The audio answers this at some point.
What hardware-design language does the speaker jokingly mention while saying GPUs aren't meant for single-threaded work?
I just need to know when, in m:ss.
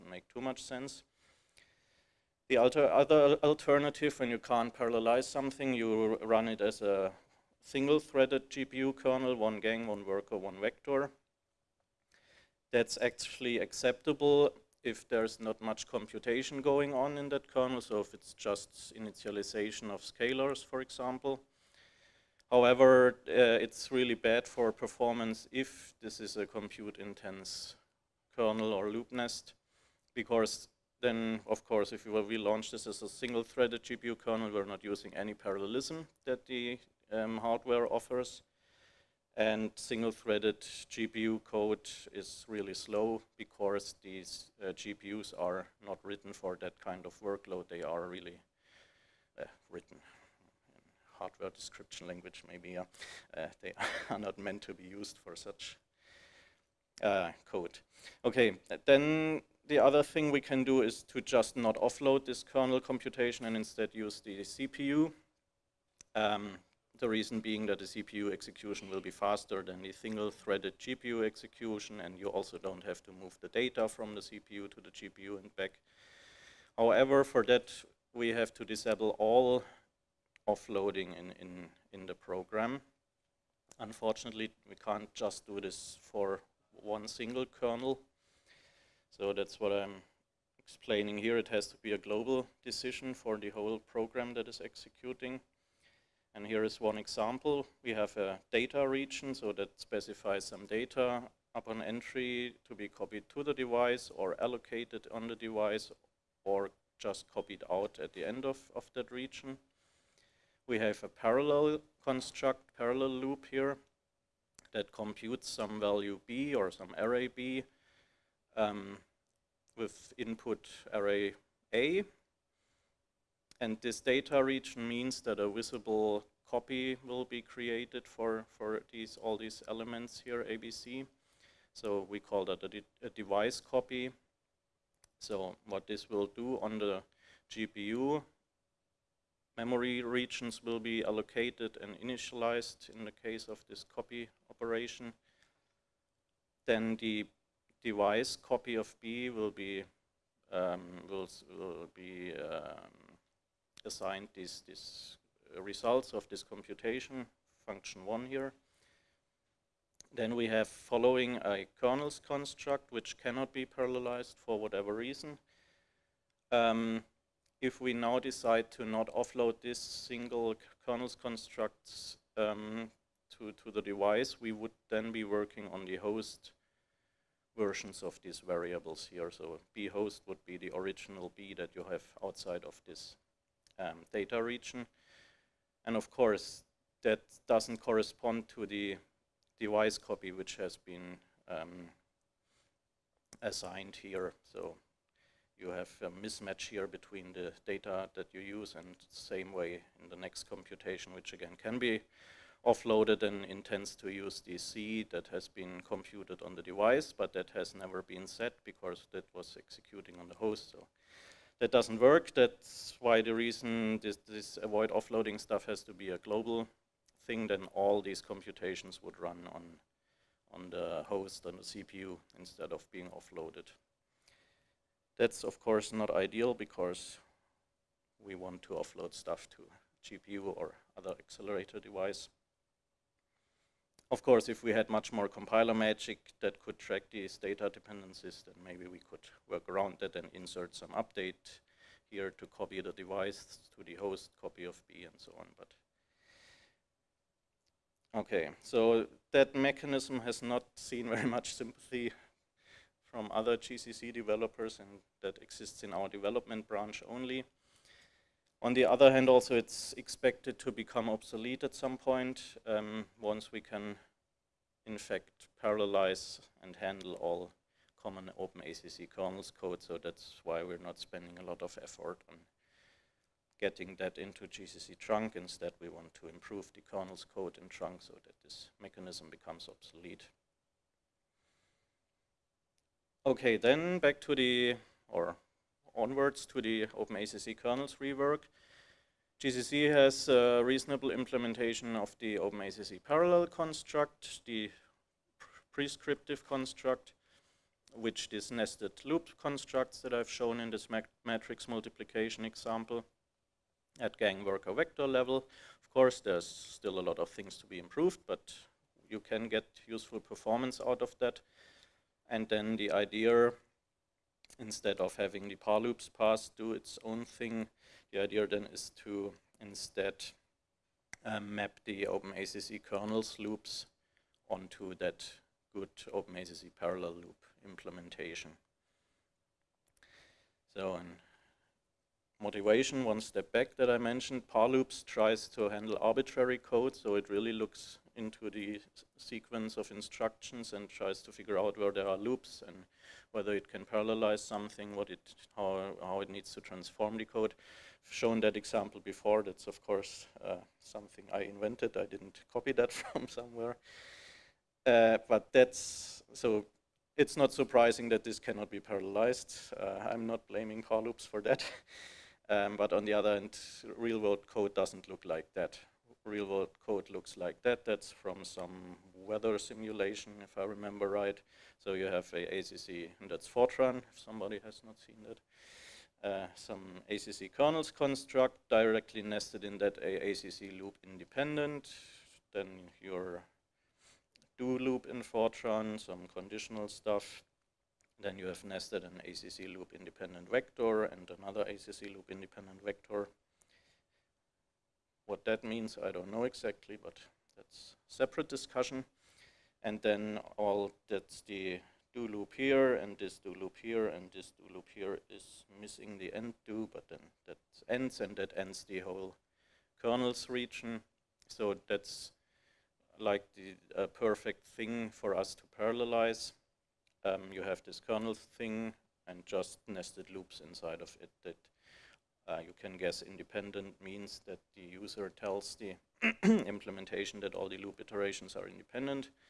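0:51.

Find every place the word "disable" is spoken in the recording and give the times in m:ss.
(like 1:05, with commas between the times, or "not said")
1:18.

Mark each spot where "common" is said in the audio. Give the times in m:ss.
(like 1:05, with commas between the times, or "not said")
4:28.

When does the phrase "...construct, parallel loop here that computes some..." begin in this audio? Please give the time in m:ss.
1:52.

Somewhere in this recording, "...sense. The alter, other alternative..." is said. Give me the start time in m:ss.
0:00.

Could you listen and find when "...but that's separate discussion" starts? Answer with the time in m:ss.
6:36.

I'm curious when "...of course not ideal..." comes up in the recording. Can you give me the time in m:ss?
3:45.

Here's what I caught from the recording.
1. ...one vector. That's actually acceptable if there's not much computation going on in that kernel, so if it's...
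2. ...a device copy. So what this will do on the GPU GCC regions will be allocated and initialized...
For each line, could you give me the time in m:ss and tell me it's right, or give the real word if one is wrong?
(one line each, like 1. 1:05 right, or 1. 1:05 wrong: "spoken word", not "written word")
1. 0:10 right
2. 2:13 wrong: "Memory", not "GCC".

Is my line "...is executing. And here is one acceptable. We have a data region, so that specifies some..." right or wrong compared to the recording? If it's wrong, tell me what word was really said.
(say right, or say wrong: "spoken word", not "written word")
wrong: "example", not "acceptable".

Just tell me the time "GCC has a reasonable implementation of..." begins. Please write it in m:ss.
4:49.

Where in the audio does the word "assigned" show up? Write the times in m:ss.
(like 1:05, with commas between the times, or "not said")
2:33, 3:13.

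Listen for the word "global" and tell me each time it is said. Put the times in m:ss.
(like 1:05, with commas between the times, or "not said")
1:31, 3:36.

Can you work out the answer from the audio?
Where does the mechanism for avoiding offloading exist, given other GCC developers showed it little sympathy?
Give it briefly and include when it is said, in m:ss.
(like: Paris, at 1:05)
development branch, at 4:16.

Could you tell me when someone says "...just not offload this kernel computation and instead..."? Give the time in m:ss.
1:01.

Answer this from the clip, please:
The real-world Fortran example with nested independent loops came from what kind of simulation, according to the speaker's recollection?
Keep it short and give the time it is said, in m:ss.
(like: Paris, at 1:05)
weather simulation, at 6:09.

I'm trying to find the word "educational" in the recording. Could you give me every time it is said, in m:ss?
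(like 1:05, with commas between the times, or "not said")
not said.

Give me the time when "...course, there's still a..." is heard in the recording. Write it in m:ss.
5:05.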